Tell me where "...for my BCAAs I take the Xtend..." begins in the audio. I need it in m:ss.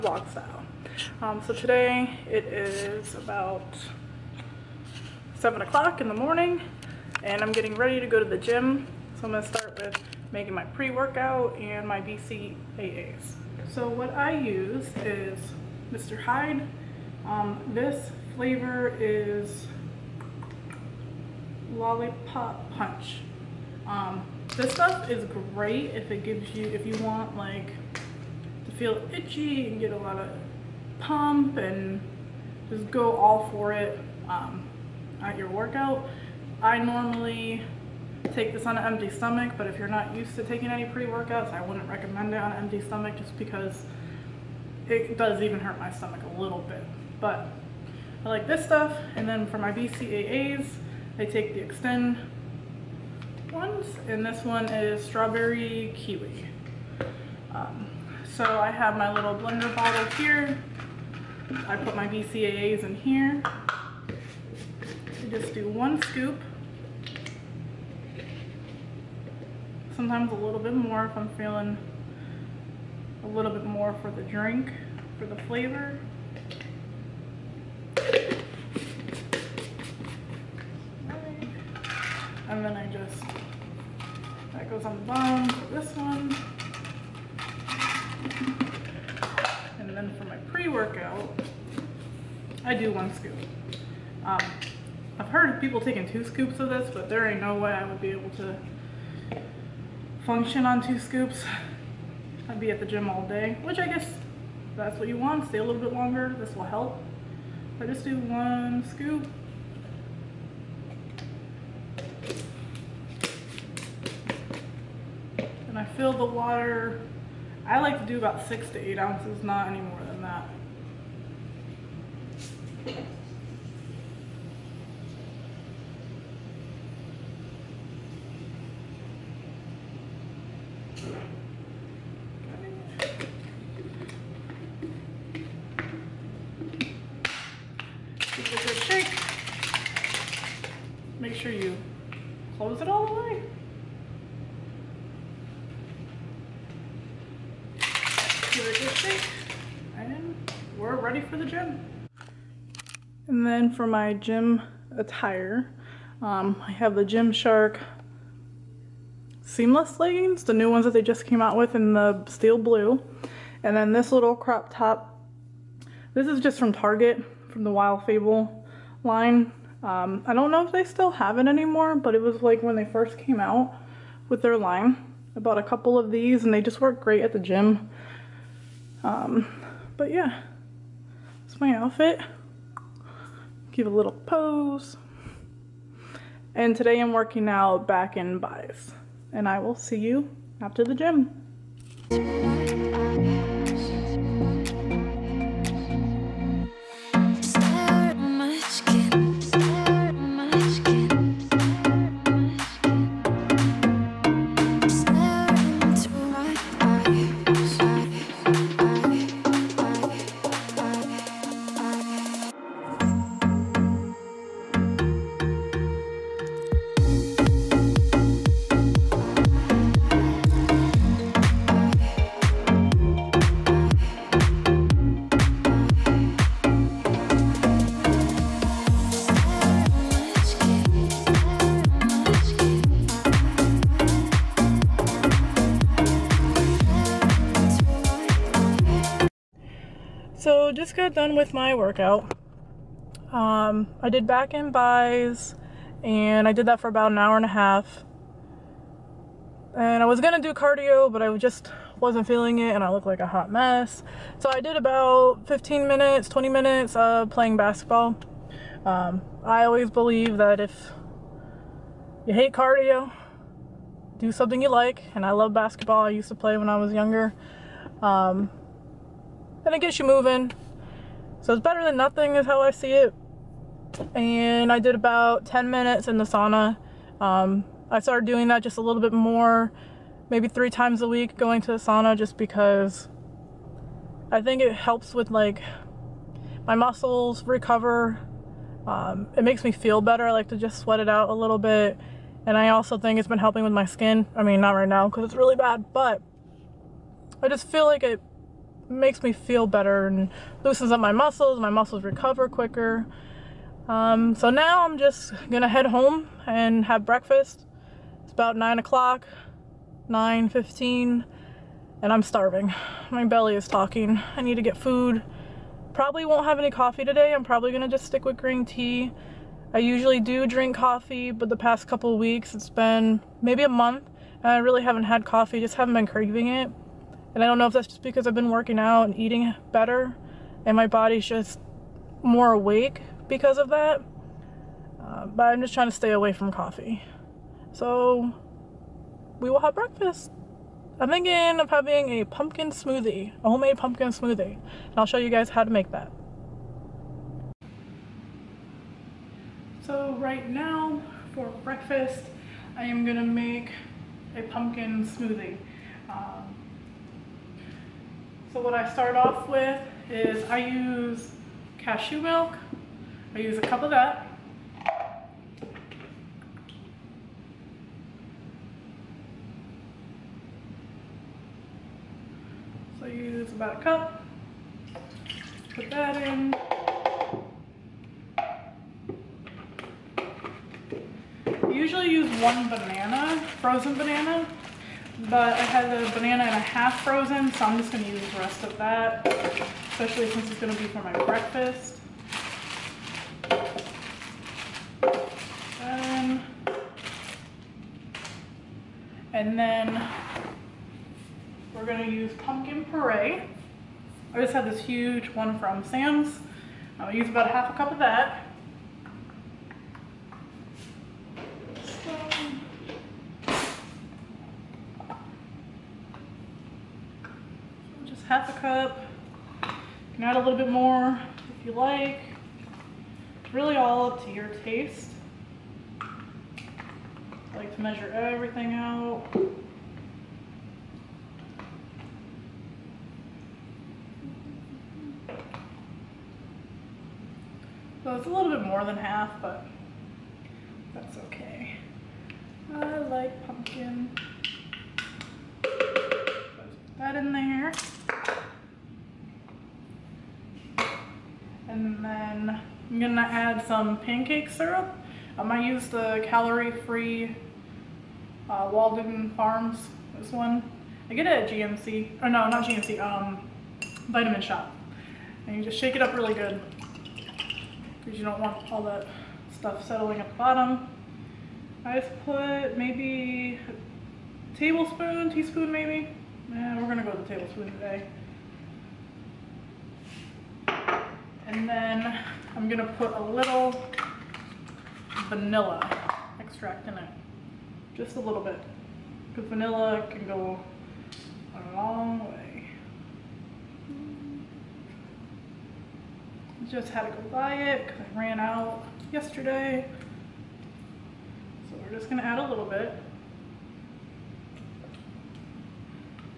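0:49.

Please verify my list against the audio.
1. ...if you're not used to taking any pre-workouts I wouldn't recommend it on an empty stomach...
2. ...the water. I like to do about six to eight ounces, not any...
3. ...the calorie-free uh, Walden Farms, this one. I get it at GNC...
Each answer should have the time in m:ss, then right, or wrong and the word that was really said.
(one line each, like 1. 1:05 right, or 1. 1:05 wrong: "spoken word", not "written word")
1. 0:39 right
2. 1:56 right
3. 7:35 right.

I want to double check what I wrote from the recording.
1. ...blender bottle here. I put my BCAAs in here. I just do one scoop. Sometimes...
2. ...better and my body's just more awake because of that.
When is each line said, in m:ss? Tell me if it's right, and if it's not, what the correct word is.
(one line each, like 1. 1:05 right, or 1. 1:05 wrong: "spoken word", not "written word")
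1. 0:59 right
2. 5:29 right.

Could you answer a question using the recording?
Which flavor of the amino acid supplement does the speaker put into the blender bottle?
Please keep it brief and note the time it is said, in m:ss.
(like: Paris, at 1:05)
strawberry kiwi, at 0:55.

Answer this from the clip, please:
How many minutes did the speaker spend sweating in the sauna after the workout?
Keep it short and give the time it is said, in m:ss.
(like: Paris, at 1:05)
10, at 4:35.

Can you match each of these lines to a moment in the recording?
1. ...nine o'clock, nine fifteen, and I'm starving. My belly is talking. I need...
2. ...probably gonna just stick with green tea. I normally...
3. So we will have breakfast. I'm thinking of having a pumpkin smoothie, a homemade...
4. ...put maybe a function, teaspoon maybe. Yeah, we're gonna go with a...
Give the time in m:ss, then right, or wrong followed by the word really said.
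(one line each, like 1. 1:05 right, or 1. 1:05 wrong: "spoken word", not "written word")
1. 5:08 right
2. 5:17 wrong: "usually", not "normally"
3. 5:37 right
4. 7:52 wrong: "tablespoon", not "function".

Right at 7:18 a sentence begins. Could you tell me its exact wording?
So it's a little bit more than half, but that's okay.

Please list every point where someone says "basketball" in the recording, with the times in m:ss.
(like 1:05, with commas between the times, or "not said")
4:17, 4:25.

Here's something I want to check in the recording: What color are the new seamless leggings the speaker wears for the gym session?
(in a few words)
steel blue.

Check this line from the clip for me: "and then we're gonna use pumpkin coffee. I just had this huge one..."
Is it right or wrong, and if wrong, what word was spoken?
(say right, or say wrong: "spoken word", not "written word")
wrong: "puree", not "coffee".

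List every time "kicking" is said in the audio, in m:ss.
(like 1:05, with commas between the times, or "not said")
not said.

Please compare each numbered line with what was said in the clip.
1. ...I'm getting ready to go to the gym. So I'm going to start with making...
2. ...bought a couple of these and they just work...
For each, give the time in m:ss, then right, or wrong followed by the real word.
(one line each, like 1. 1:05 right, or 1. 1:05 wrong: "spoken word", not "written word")
1. 0:07 right
2. 2:55 right.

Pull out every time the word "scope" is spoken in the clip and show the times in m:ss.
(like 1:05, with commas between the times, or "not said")
not said.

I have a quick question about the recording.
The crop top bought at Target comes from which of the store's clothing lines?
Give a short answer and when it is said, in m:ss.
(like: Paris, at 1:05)
Wild Fable, at 2:47.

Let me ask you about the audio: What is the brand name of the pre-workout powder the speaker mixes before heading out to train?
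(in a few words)
Mr. Hyde.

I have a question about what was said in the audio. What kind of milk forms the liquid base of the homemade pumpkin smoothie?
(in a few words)
cashew milk.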